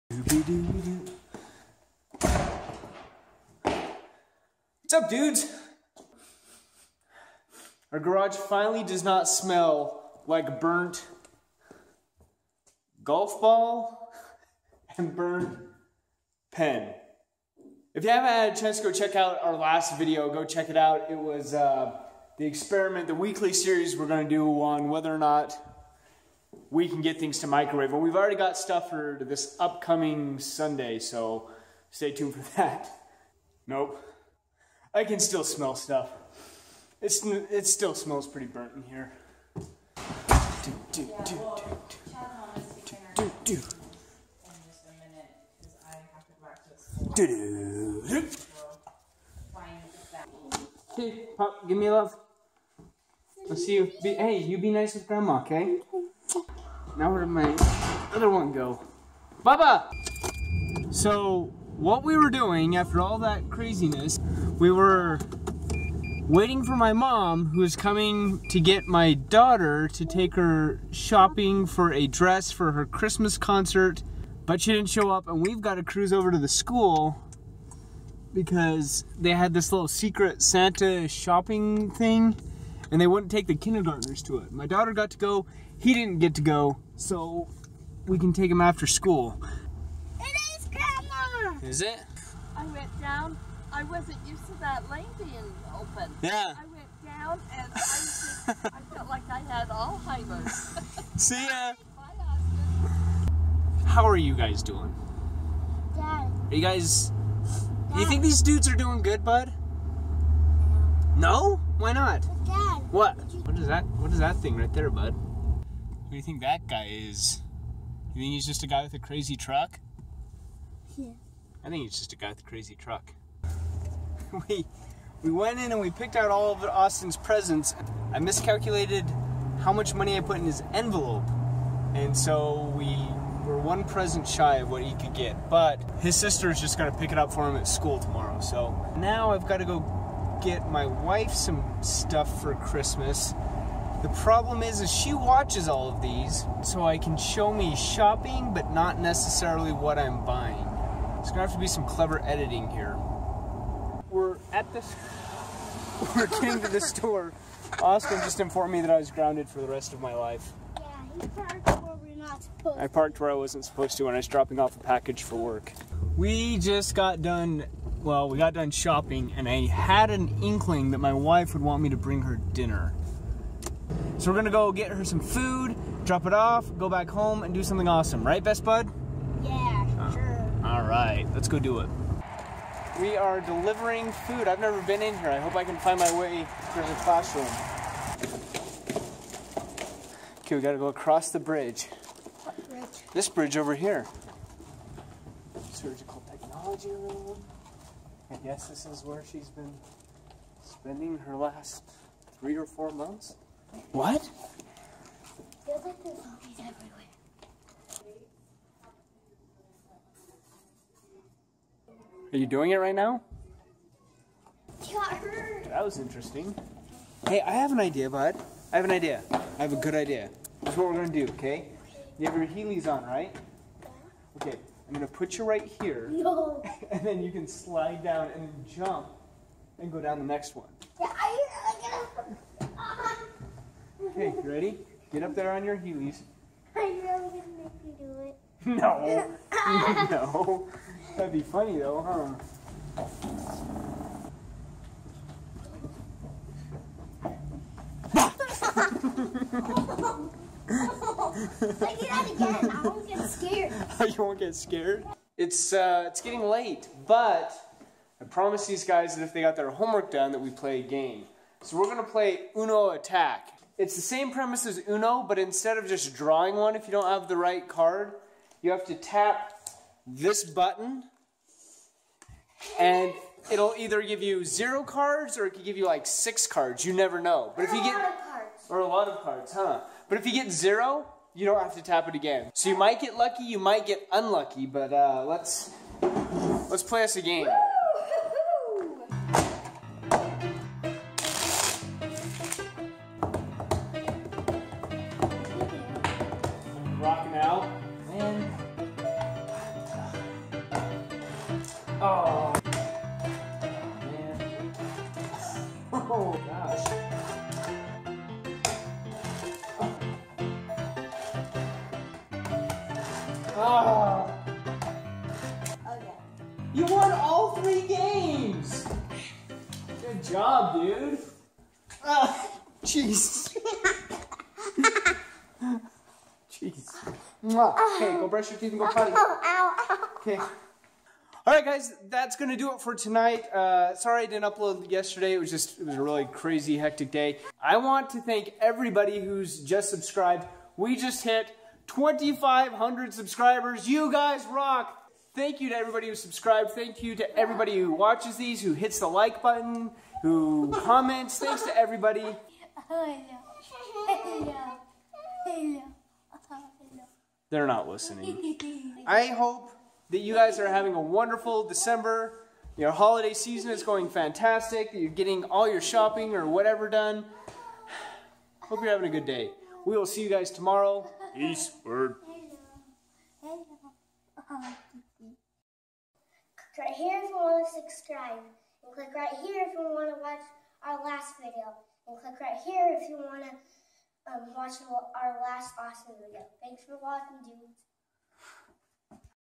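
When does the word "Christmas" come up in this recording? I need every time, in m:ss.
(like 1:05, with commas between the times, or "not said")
1:12, 2:22.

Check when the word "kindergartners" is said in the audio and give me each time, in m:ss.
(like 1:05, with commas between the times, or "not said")
1:23.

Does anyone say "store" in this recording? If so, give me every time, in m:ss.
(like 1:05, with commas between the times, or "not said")
2:36.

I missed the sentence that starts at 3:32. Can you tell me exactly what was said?
Are you doing it right now?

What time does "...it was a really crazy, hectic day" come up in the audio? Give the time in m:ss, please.
5:35.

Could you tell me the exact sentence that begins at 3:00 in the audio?
All right, let's go do it.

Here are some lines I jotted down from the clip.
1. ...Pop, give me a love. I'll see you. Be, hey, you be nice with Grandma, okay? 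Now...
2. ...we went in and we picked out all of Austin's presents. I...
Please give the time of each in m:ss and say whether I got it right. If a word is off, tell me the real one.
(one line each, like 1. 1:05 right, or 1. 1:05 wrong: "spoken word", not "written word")
1. 0:51 right
2. 2:05 right.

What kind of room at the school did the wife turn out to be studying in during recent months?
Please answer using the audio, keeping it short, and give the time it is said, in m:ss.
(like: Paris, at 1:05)
Surgical technology room, at 3:15.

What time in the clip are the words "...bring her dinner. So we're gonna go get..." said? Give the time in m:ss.
2:51.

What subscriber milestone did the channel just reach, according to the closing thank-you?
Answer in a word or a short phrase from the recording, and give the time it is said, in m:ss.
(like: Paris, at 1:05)
2,500, at 5:41.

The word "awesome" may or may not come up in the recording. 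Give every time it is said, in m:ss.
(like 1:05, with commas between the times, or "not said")
2:57, 6:25.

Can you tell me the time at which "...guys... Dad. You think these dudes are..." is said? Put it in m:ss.
1:46.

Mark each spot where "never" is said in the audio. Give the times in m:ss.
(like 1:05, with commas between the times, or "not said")
3:04, 4:36.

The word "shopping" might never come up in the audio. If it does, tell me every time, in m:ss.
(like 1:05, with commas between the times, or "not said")
1:10, 1:21, 2:27, 2:48, 6:05.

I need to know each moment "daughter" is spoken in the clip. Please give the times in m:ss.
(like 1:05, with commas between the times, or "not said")
1:09, 1:24.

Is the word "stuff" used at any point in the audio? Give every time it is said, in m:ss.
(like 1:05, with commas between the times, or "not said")
0:28, 0:35, 2:21.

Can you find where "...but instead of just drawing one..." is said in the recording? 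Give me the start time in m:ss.
4:25.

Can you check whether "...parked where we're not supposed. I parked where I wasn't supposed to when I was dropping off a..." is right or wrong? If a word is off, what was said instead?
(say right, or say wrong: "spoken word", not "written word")
right.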